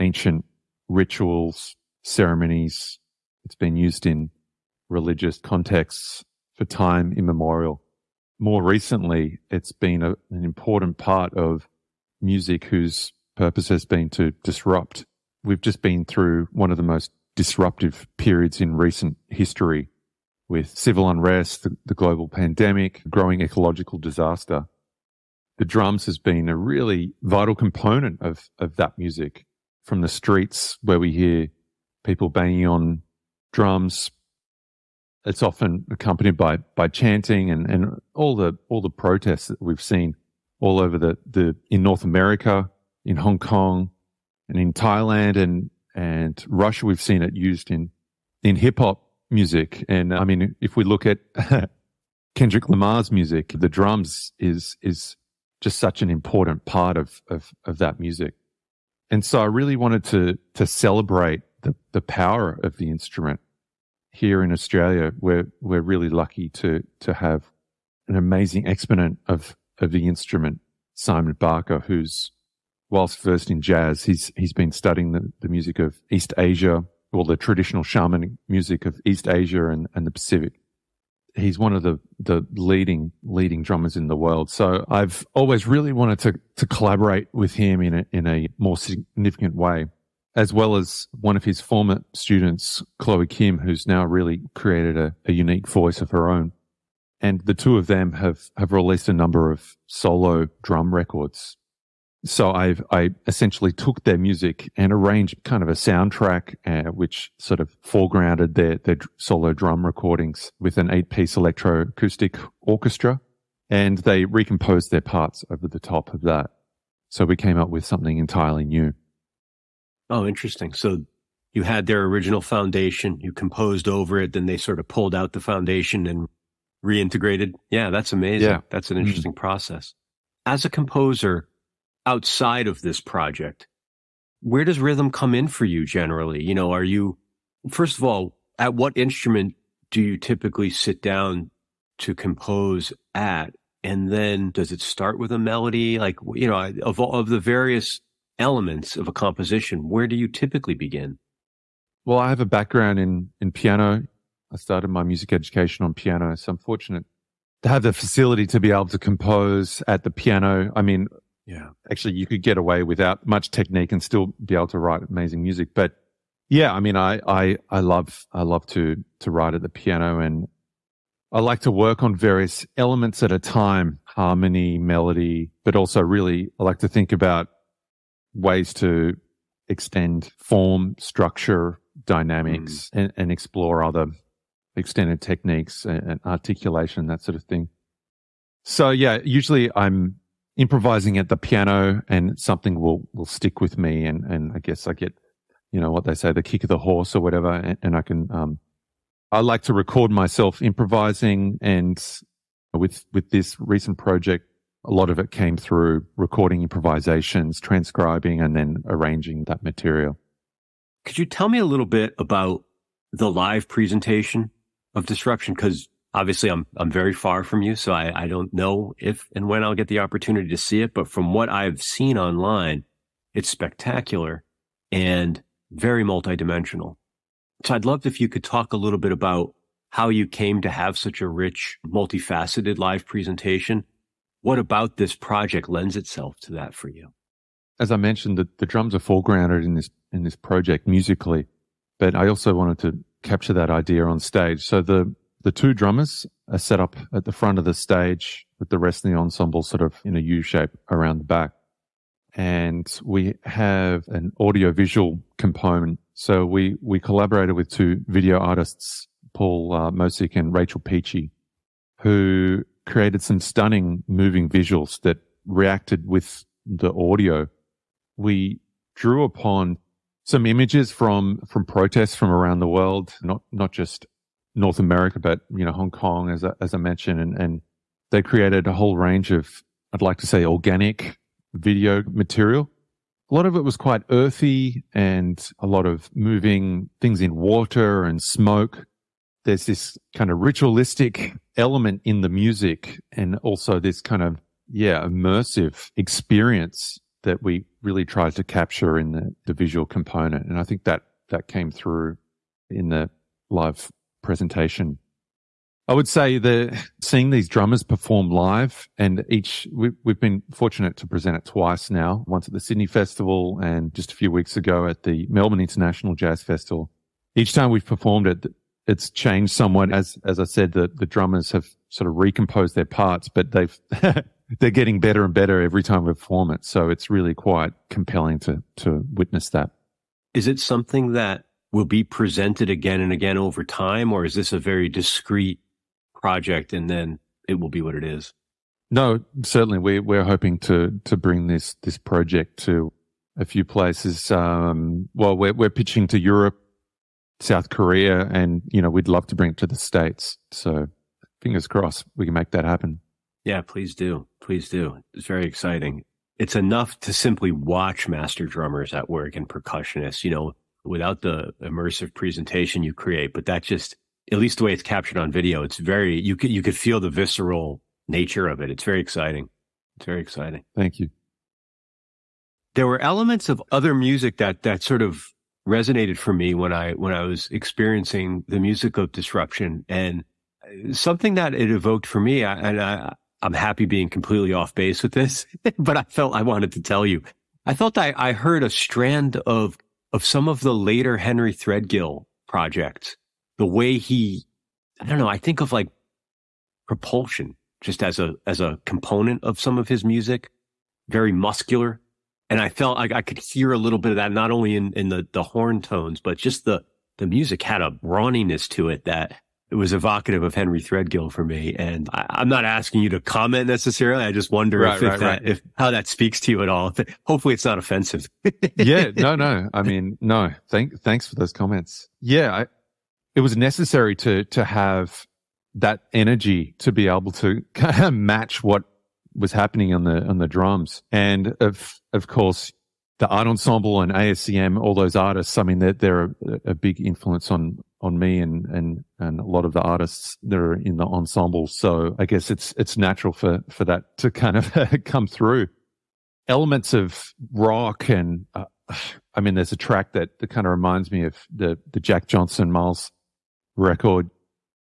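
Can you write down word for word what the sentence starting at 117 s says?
So we came up with something entirely new.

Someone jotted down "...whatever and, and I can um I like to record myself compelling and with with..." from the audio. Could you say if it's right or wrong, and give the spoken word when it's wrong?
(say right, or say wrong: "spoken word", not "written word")
wrong: "improvising", not "compelling".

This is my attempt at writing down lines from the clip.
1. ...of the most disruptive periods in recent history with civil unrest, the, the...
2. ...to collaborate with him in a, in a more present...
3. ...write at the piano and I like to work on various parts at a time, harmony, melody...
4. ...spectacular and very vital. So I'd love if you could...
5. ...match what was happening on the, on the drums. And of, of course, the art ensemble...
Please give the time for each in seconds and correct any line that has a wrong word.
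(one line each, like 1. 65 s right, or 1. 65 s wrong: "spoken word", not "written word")
1. 16 s right
2. 86 s wrong: "significant", not "present"
3. 169 s wrong: "elements", not "parts"
4. 223 s wrong: "multidimensional", not "vital"
5. 428 s right.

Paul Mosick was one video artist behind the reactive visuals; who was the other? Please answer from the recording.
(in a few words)
Rachel Peachy.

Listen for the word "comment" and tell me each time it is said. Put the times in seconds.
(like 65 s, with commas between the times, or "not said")
413 s, 421 s.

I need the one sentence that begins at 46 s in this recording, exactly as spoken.
We've seen it used in, in hip hop music.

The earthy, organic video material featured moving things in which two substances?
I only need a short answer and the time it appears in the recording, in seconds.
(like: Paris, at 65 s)
Water and smoke, at 287 s.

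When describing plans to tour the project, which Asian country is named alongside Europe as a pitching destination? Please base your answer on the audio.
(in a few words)
South Korea.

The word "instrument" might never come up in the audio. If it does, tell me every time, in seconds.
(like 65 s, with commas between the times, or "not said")
62 s, 70 s, 138 s.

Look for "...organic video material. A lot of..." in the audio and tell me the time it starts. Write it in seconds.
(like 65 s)
280 s.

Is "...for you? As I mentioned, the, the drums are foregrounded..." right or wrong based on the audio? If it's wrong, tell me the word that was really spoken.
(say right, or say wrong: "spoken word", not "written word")
right.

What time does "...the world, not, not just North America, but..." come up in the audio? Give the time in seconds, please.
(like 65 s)
272 s.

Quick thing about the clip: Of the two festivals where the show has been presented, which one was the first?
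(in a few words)
Sydney Festival.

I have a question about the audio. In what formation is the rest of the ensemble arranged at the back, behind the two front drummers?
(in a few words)
U shape.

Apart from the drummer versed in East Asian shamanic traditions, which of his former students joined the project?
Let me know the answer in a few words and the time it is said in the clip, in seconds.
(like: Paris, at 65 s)
Chloe Kim, at 92 s.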